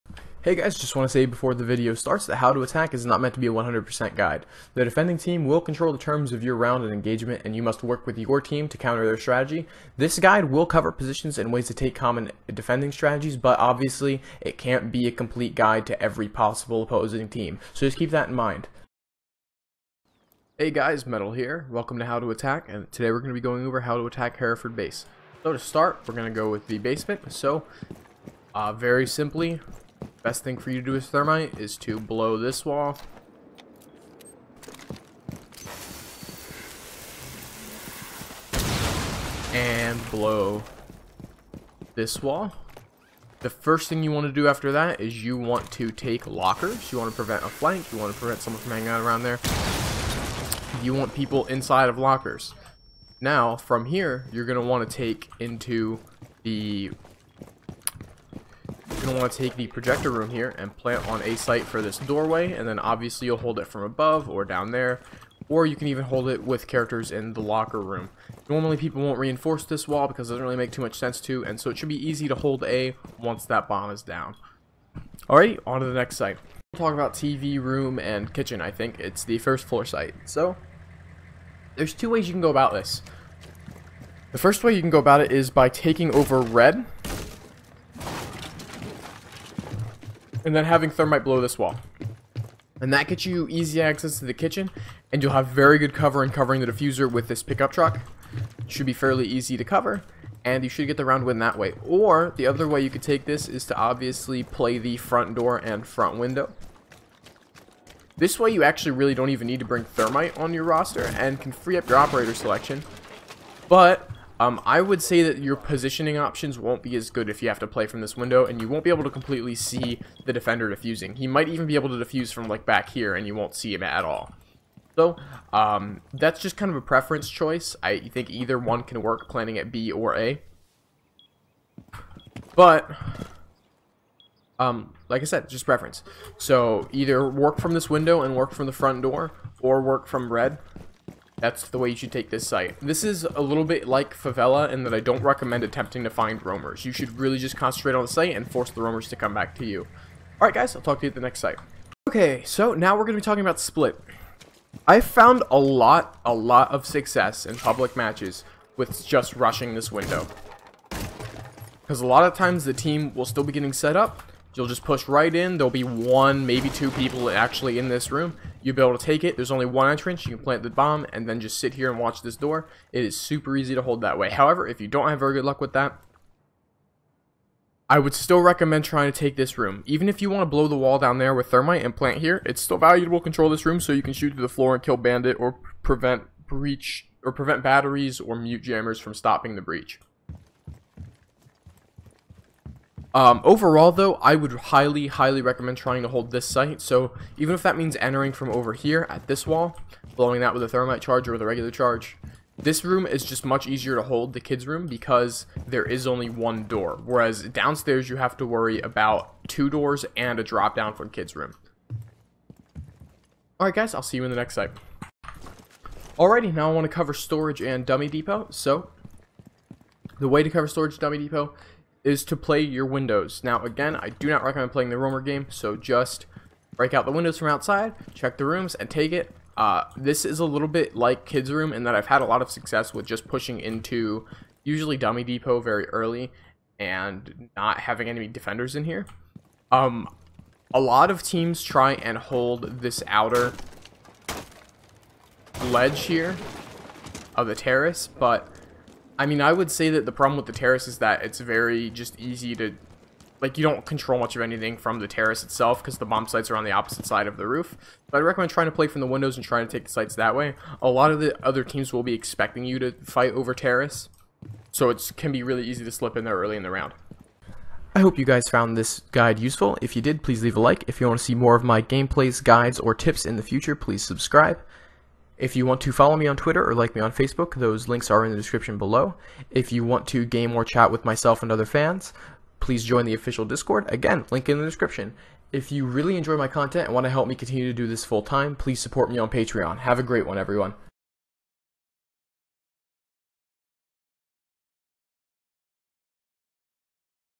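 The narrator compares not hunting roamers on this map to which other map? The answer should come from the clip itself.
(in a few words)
Favela.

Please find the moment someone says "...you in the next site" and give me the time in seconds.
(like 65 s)
214 s.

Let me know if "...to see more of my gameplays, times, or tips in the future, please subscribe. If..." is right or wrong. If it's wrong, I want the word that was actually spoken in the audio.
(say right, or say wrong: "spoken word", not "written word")
wrong: "guides", not "times".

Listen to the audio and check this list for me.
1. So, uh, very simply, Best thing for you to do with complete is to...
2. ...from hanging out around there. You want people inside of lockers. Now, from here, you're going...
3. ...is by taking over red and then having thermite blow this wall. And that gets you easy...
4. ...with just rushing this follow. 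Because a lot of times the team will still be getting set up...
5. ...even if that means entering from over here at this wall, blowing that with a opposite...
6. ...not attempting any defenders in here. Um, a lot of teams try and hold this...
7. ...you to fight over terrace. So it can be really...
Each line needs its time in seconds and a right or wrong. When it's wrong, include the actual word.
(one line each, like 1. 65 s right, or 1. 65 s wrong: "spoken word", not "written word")
1. 27 s wrong: "thermite", not "complete"
2. 48 s right
3. 85 s right
4. 158 s wrong: "window", not "follow"
5. 197 s wrong: "thermite", not "opposite"
6. 237 s wrong: "having", not "attempting"
7. 262 s right.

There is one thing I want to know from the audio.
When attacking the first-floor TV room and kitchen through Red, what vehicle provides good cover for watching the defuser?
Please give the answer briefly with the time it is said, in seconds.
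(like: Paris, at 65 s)
Pickup truck, at 97 s.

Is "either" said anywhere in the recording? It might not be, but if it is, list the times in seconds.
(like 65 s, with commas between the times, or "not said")
128 s, 136 s.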